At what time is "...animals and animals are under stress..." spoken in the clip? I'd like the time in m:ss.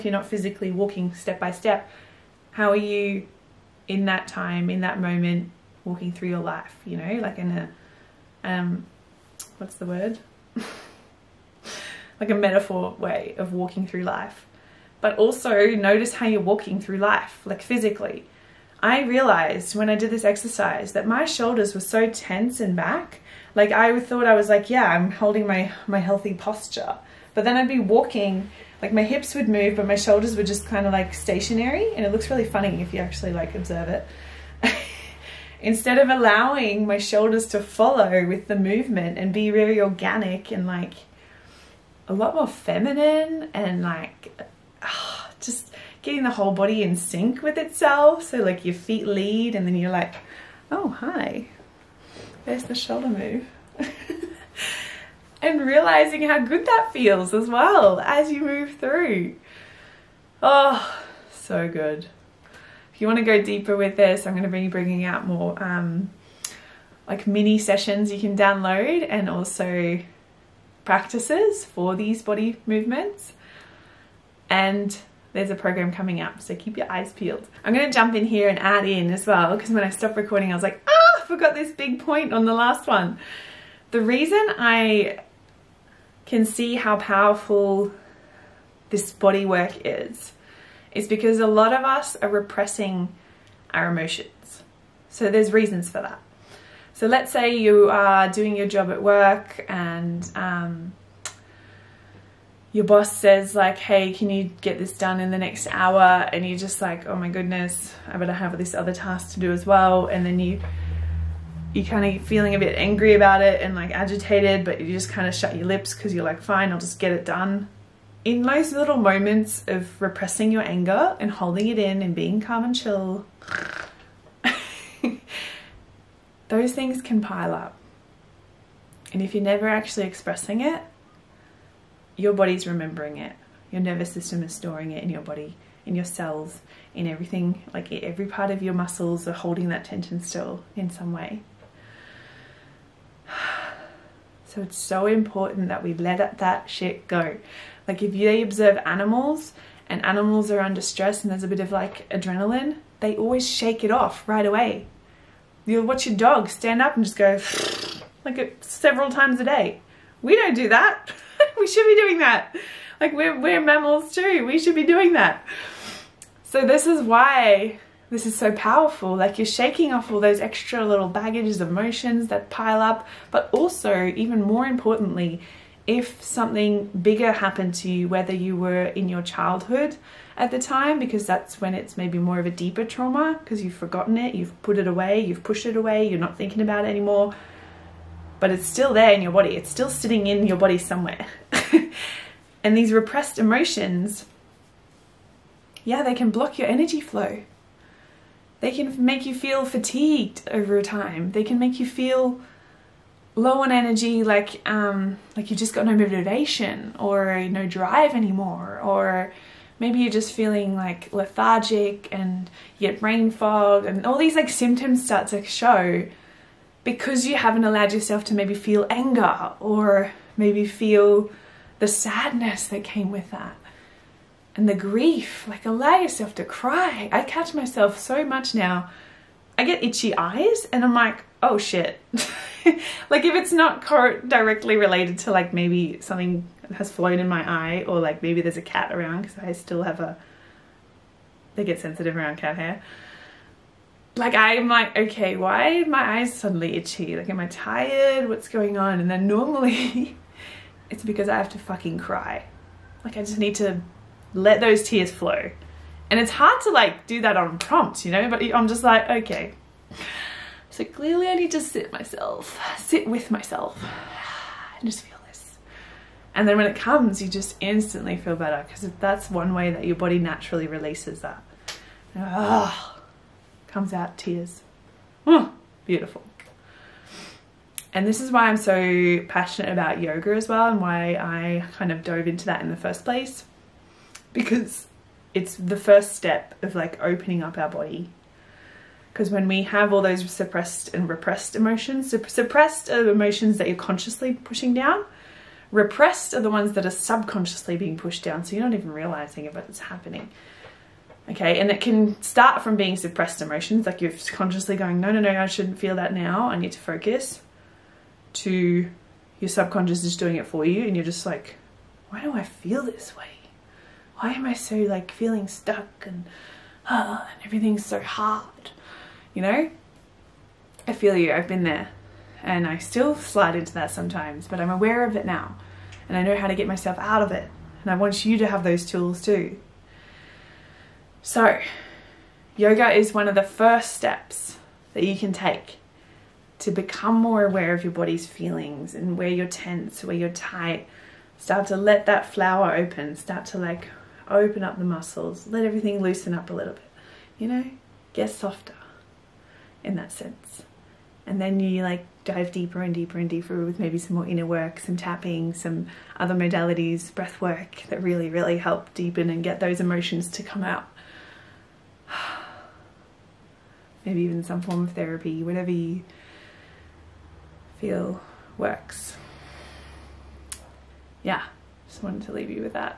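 2:28.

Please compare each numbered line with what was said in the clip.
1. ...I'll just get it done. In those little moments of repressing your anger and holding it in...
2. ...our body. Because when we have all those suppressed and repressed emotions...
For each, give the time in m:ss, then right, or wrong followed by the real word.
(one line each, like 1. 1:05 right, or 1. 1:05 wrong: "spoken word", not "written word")
1. 1:56 right
2. 4:47 right.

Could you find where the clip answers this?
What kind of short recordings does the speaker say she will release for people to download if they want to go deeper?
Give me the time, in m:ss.
1:07.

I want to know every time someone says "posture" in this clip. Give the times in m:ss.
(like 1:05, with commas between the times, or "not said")
0:26.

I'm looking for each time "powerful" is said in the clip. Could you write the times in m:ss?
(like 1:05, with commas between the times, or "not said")
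1:26, 2:48.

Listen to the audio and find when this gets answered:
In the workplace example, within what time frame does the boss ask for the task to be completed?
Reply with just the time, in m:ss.
1:45.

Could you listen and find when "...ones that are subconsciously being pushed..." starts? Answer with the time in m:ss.
4:56.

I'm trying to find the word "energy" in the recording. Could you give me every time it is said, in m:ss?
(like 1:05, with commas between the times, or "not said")
3:16, 3:23.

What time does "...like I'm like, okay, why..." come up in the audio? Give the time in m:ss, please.
4:04.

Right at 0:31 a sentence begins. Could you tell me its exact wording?
And it looks really funny if you actually like observe it.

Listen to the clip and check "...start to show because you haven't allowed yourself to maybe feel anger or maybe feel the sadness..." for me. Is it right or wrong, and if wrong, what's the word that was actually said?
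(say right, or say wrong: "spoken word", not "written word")
right.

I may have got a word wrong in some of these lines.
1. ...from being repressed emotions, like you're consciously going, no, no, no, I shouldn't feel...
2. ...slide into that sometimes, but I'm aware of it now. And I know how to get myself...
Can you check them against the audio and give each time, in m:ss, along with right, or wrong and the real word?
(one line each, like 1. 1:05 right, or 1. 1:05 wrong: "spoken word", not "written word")
1. 5:02 wrong: "suppressed", not "repressed"
2. 5:23 right.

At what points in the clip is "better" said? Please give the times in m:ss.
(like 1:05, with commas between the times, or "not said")
1:48, 4:28.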